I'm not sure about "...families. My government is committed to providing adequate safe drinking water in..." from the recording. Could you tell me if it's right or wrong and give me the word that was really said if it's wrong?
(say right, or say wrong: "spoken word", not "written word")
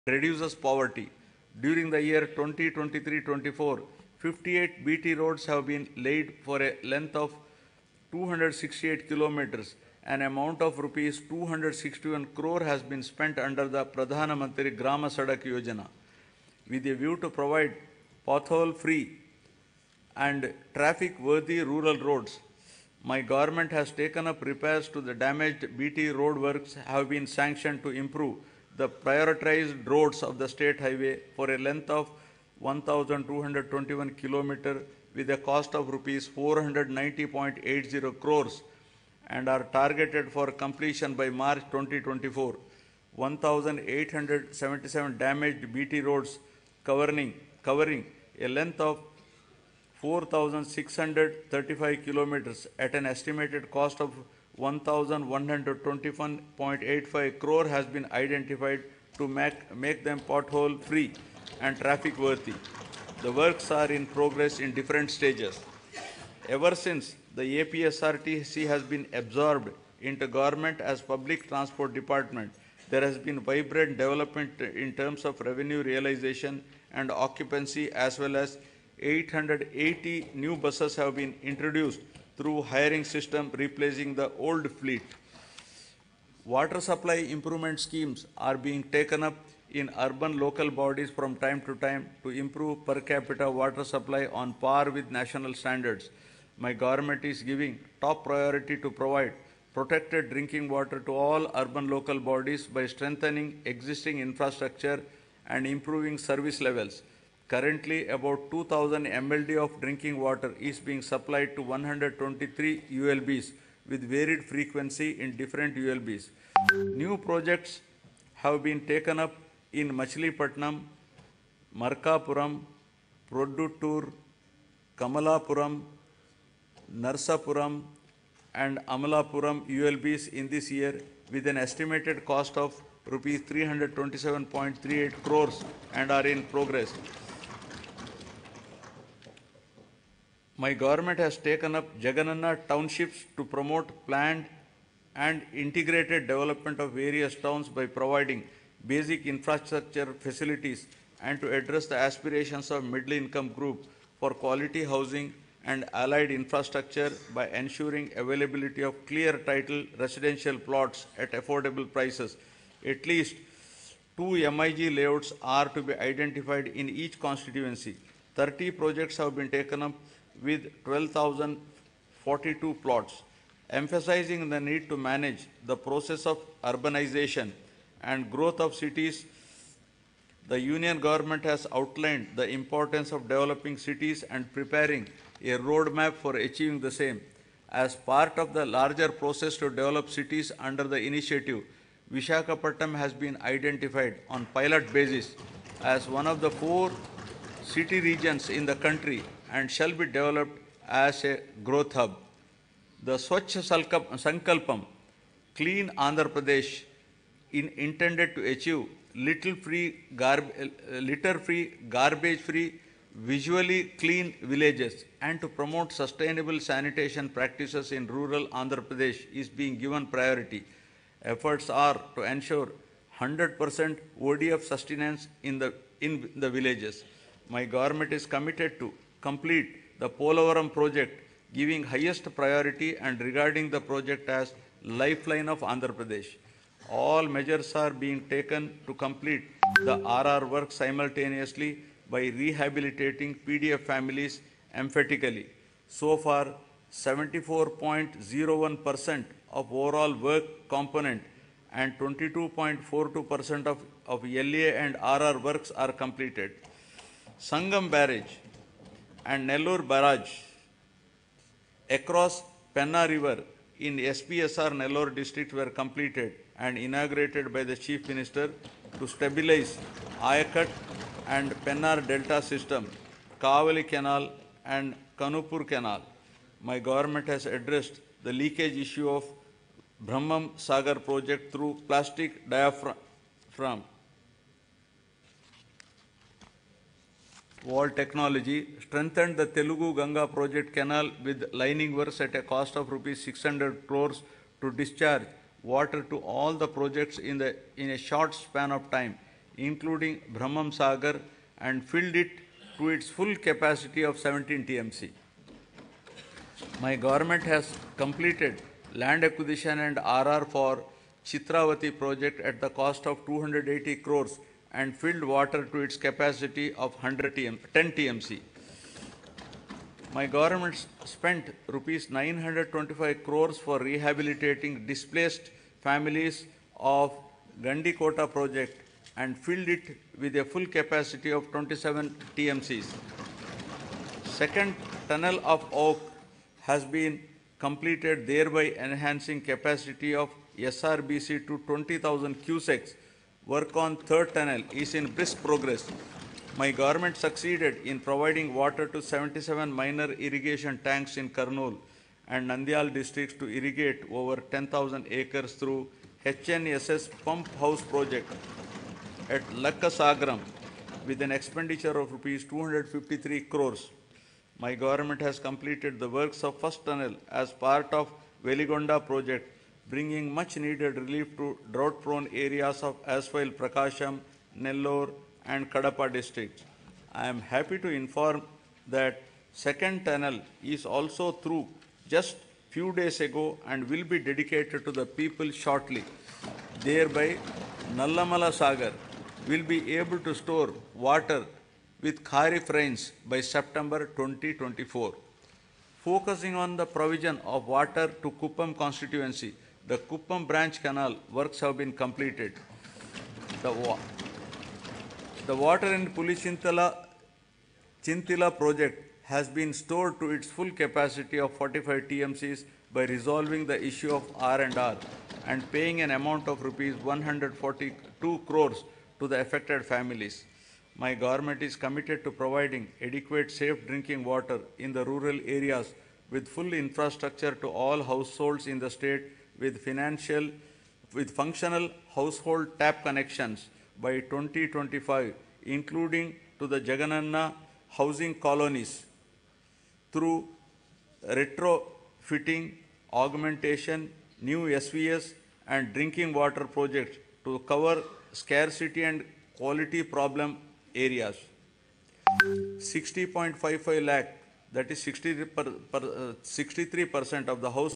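right.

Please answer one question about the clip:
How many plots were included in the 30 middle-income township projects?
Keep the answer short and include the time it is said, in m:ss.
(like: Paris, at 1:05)
12,042, at 2:50.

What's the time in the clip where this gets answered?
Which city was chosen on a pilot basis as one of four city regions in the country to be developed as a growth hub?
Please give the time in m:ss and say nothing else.
3:12.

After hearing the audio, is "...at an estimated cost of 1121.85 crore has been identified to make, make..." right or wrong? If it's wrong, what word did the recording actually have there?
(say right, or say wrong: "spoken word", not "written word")
right.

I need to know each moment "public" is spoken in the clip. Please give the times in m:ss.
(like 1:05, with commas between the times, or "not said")
1:11.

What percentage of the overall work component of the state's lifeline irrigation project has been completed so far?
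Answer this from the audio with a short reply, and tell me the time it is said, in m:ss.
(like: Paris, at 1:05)
74.01%, at 4:06.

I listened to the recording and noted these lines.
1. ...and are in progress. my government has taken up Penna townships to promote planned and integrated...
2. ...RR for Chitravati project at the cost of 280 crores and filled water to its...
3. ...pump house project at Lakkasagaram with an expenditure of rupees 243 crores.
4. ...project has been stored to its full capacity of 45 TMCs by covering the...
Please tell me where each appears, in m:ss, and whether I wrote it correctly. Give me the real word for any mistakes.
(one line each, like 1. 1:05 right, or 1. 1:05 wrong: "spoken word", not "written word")
1. 2:15 wrong: "Jagananna", not "Penna"
2. 5:09 right
3. 5:57 wrong: "253", not "243"
4. 6:48 wrong: "resolving", not "covering".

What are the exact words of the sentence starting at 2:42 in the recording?
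At least two MIG layouts are to be identified in each constituency.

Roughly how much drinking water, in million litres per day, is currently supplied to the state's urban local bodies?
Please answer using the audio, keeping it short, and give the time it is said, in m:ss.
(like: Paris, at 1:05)
2000 mld, at 1:48.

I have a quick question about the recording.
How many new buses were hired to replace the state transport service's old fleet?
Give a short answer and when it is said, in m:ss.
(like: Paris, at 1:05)
880, at 1:18.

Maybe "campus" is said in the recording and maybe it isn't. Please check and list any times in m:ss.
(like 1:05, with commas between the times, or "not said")
not said.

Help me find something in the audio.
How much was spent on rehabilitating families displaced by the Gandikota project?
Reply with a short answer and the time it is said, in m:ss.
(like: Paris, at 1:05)
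925 crore rupees, at 5:22.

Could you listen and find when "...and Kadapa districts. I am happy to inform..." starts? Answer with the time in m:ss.
6:15.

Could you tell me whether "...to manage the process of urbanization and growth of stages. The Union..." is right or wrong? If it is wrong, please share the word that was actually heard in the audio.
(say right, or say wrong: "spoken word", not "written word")
wrong: "cities", not "stages".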